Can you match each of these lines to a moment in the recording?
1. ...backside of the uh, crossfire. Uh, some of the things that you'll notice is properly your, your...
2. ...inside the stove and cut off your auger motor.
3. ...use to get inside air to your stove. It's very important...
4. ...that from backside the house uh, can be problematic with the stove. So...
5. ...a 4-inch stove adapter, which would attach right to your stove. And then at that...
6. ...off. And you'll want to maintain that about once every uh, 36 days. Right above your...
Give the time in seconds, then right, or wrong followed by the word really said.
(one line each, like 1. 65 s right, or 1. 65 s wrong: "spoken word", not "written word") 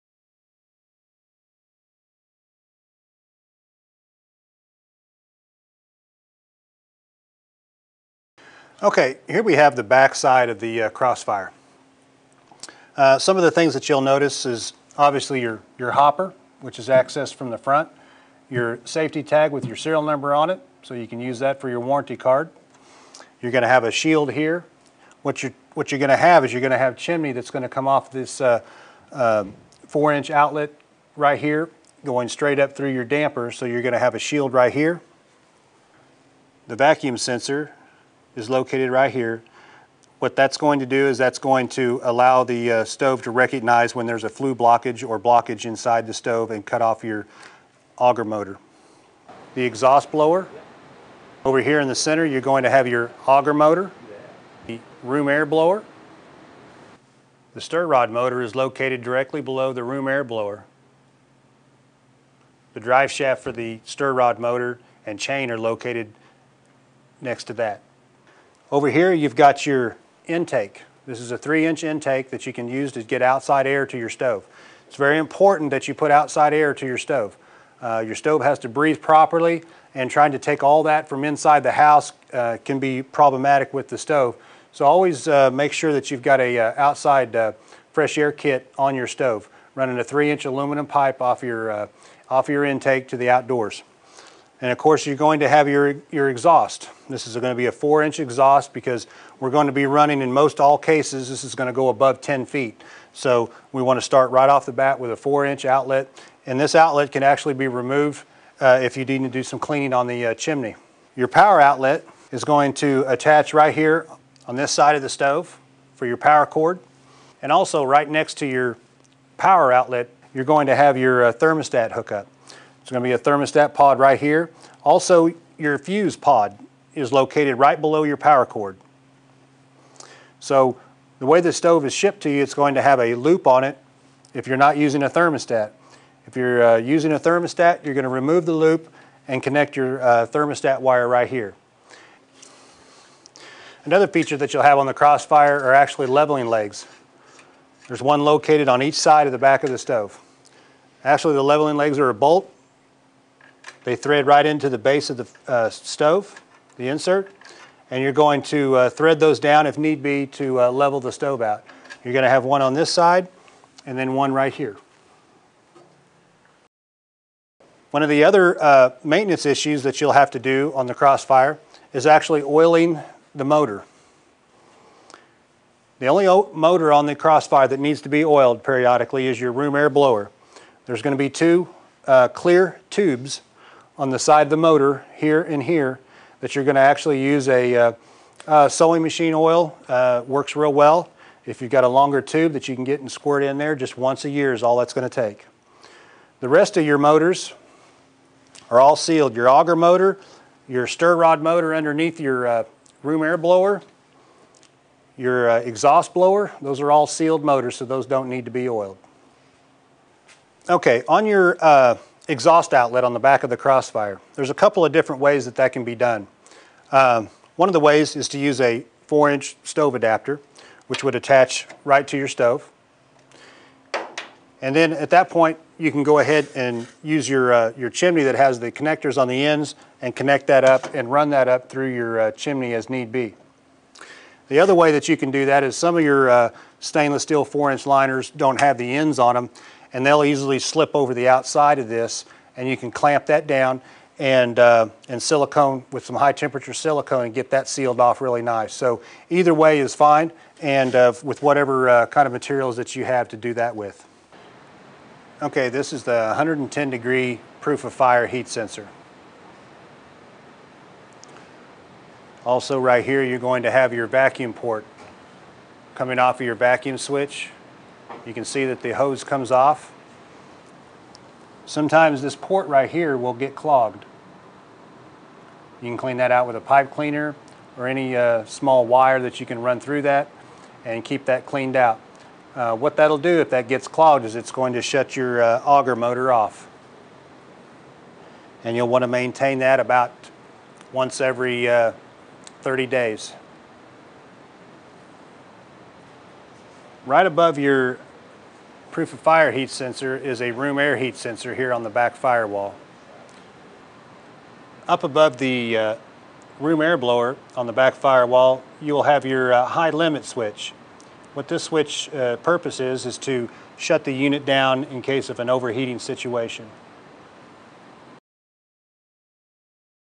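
1. 9 s wrong: "obviously", not "properly"
2. 45 s right
3. 72 s wrong: "outside", not "inside"
4. 80 s wrong: "inside", not "backside"
5. 218 s right
6. 286 s wrong: "30", not "36".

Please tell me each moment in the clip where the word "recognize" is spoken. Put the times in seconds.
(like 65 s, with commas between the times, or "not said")
43 s.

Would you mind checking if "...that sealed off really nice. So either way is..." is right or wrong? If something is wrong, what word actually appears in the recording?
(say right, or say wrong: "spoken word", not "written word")
right.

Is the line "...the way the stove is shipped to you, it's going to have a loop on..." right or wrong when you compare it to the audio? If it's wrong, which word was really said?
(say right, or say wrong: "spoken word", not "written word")
right.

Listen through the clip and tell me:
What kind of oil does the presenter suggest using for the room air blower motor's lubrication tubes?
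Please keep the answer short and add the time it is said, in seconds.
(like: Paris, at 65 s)
sewing machine oil, at 188 s.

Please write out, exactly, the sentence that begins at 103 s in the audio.
So we want to start right off the bat with a four inch outlet.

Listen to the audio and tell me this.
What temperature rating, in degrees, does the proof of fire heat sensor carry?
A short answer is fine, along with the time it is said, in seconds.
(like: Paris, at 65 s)
110 degrees, at 256 s.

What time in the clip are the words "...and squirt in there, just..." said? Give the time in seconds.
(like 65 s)
192 s.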